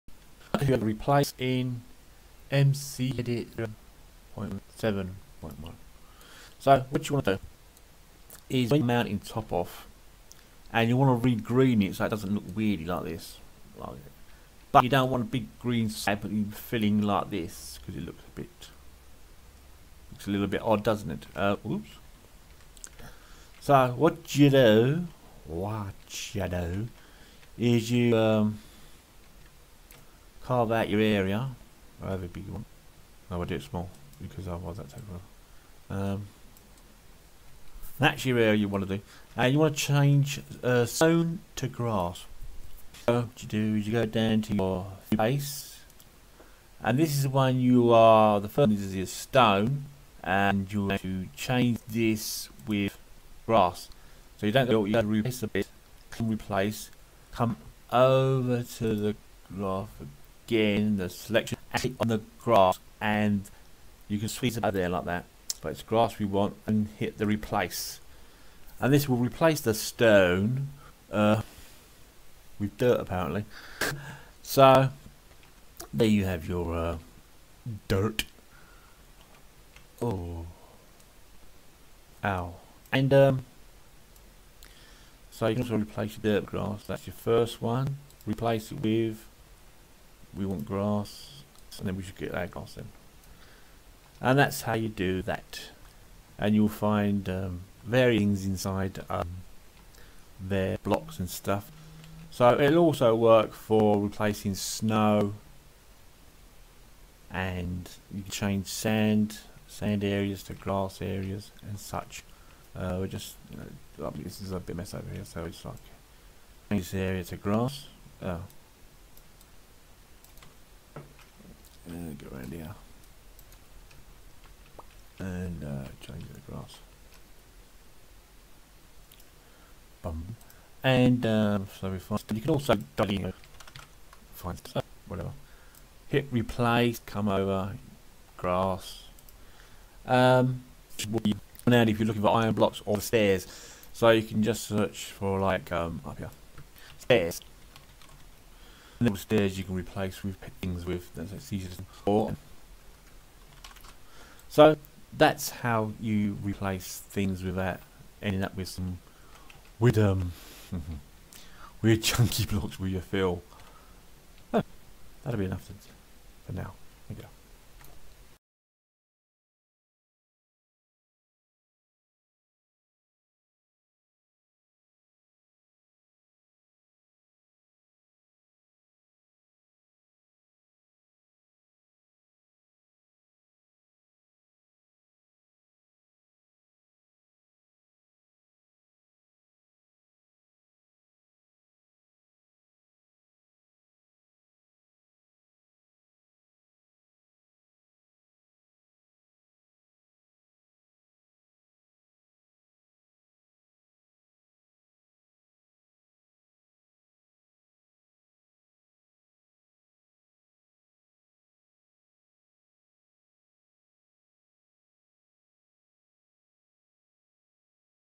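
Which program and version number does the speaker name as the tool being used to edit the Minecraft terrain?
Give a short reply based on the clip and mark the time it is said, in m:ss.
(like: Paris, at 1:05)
MC edit 7.1, at 0:02.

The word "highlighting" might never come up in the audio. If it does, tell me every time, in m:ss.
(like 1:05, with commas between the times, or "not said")
not said.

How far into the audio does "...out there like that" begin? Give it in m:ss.
1:04.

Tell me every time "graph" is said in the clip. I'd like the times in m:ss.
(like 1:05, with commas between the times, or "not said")
0:59.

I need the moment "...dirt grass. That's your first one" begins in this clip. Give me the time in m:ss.
1:26.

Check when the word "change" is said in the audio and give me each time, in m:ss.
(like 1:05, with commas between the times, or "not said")
0:39, 0:51, 1:48, 1:56, 2:06.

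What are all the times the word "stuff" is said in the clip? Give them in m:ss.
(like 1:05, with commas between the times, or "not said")
1:41, 2:14.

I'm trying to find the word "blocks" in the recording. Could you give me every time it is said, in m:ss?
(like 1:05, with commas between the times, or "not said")
1:40, 2:22, 2:42.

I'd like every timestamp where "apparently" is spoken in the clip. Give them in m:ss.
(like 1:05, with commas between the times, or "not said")
1:12.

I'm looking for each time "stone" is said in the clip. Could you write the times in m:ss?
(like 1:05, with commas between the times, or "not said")
0:40, 0:49, 1:09.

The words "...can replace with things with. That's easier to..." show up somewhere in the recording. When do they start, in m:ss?
2:29.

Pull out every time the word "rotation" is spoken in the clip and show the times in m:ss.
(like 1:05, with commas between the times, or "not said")
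not said.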